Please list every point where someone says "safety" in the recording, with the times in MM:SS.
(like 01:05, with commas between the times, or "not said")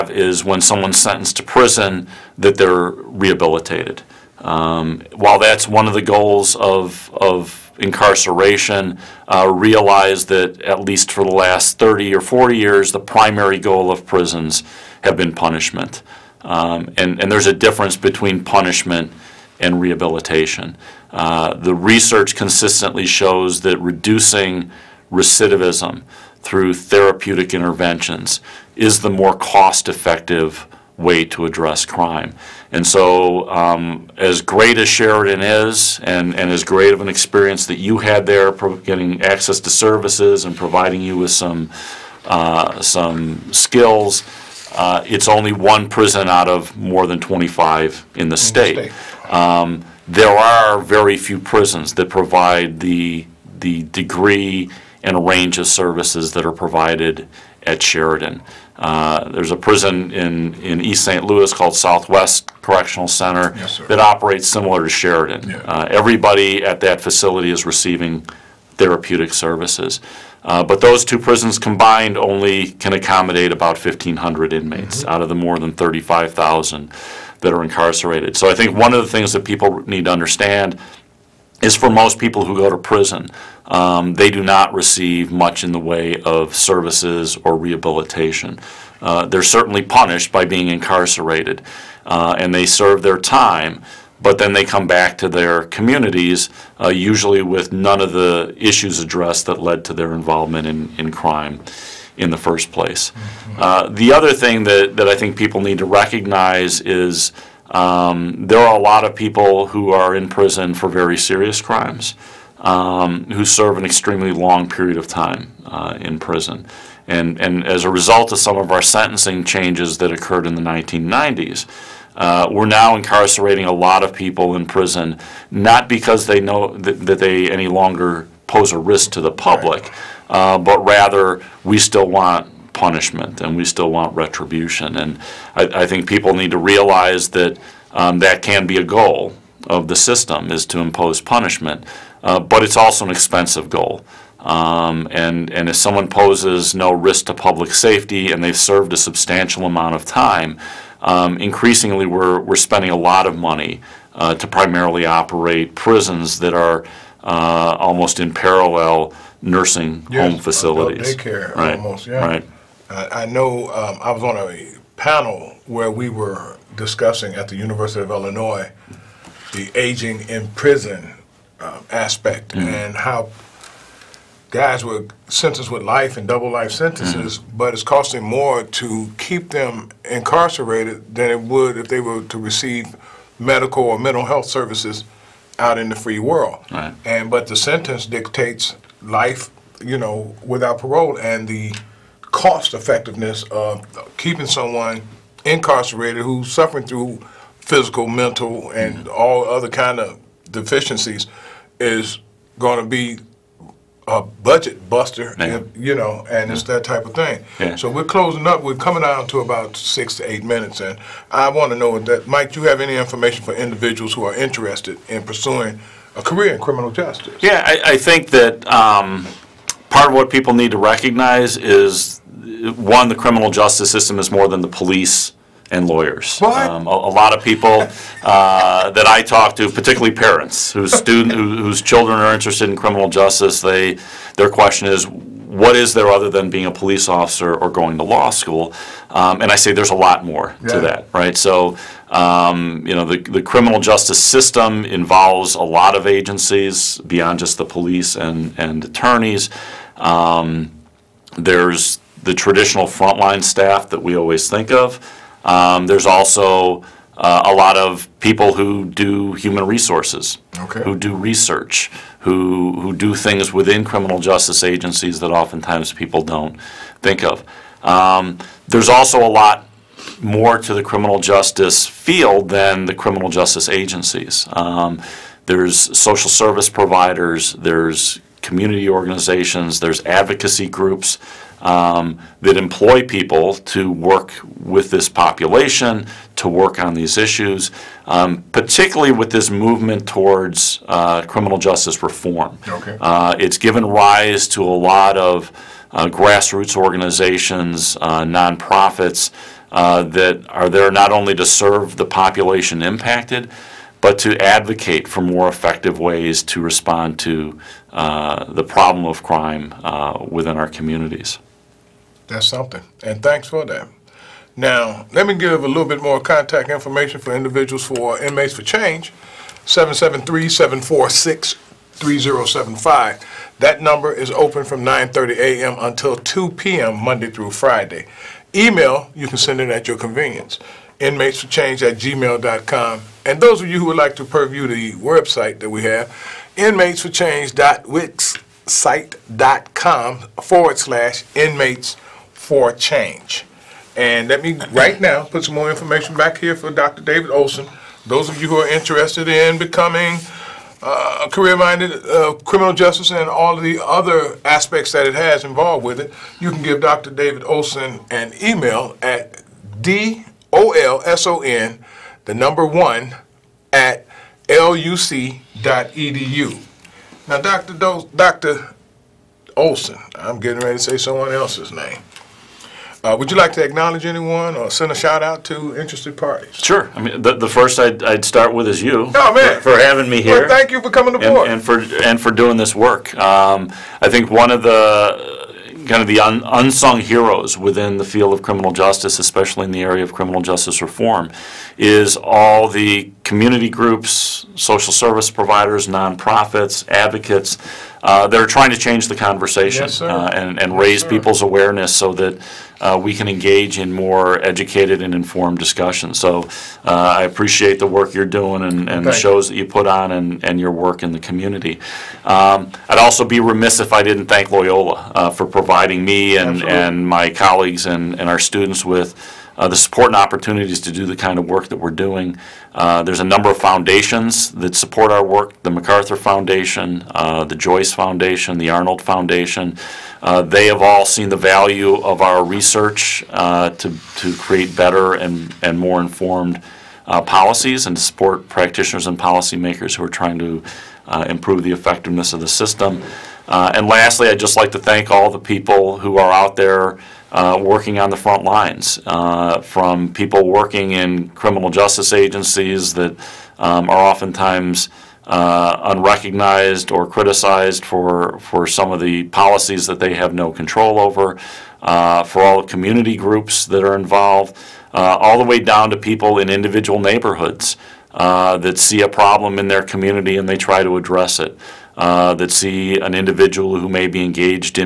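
02:27.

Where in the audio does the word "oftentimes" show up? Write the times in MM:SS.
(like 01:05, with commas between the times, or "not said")
04:25, 07:34.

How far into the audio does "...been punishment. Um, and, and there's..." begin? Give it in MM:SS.
00:15.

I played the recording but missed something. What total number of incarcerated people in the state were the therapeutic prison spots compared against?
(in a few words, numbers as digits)
35,000.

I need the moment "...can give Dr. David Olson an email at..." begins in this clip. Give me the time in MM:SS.
05:56.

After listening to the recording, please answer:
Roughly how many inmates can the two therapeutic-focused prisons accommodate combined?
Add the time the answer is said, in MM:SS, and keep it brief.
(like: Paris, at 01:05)
1,500, at 01:13.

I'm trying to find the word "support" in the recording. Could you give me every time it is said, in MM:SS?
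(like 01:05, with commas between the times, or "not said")
06:59, 07:04, 07:17.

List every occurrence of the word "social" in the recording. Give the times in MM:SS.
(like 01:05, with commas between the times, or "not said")
04:35, 06:34.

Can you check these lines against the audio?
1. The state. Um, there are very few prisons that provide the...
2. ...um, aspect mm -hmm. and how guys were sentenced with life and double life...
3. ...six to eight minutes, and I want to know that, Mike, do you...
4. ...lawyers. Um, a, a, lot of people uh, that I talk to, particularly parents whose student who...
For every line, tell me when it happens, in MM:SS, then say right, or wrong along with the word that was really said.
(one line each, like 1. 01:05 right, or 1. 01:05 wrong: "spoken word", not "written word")
1. 00:48 right
2. 02:51 right
3. 03:29 right
4. 03:45 right.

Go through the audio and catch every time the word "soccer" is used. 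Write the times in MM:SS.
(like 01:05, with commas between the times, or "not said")
not said.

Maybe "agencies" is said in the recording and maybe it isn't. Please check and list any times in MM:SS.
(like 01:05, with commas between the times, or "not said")
04:06, 04:24, 04:33, 07:32.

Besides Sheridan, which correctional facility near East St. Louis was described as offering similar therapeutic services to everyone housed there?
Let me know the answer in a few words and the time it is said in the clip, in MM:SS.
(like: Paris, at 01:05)
Southwest Correctional Center, at 01:01.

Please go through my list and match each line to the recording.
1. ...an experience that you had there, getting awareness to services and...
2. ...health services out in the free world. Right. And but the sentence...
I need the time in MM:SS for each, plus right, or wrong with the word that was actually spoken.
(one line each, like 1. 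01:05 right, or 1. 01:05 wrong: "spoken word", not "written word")
1. 00:37 wrong: "access", not "awareness"
2. 03:04 right.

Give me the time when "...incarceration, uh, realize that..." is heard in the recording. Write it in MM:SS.
00:07.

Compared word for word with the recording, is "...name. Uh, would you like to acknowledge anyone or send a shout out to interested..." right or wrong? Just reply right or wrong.
right.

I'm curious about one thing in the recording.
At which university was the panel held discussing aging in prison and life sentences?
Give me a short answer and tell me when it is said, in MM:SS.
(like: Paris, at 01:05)
University of Illinois, at 02:47.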